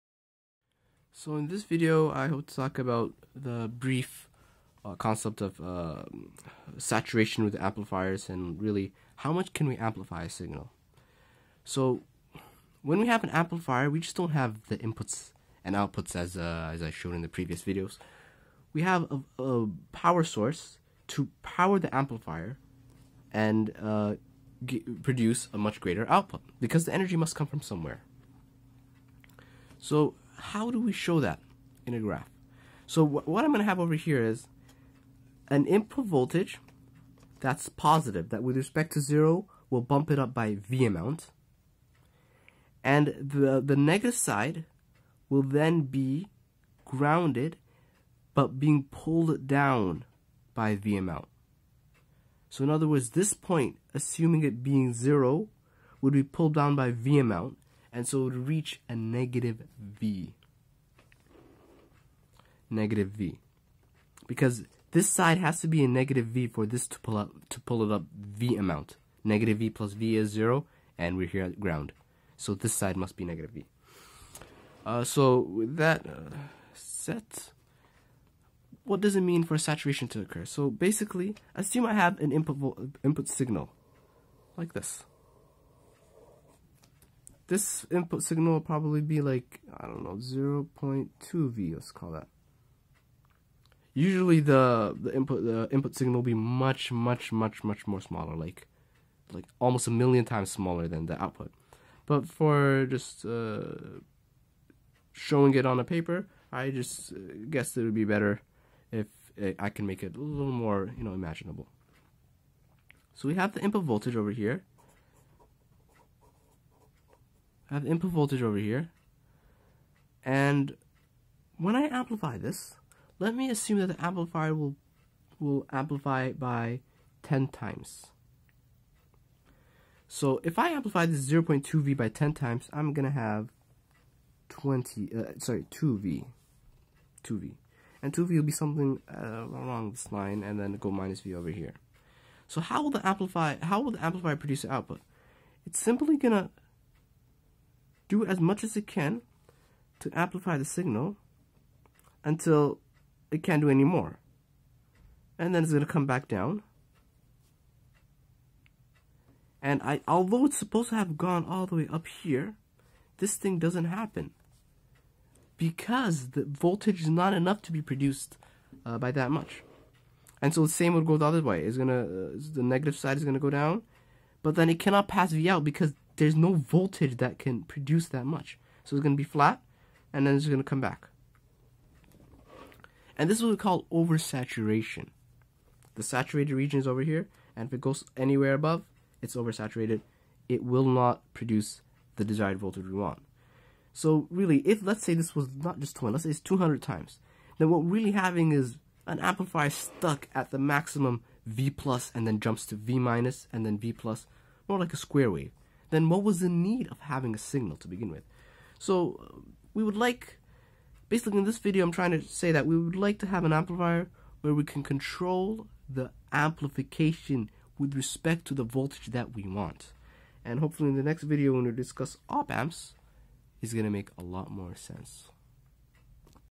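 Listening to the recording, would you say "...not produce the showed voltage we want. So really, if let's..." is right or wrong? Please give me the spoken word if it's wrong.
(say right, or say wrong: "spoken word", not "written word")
wrong: "desired", not "showed".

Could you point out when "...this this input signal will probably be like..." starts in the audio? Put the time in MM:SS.
01:24.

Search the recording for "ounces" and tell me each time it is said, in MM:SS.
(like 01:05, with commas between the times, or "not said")
not said.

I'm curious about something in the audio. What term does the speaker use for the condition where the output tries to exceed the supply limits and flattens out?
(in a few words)
oversaturation.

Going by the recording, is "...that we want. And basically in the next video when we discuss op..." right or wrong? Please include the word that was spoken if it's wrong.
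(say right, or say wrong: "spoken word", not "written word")
wrong: "hopefully", not "basically".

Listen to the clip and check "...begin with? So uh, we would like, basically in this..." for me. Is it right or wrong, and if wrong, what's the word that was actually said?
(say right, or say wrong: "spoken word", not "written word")
right.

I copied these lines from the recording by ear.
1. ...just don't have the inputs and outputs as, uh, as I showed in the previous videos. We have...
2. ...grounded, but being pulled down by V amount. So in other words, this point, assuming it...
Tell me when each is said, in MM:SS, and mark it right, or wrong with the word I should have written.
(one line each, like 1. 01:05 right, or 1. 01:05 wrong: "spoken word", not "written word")
1. 00:13 right
2. 00:46 right.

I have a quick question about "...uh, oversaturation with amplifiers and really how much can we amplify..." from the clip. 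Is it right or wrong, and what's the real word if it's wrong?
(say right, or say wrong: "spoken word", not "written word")
wrong: "saturation", not "oversaturation".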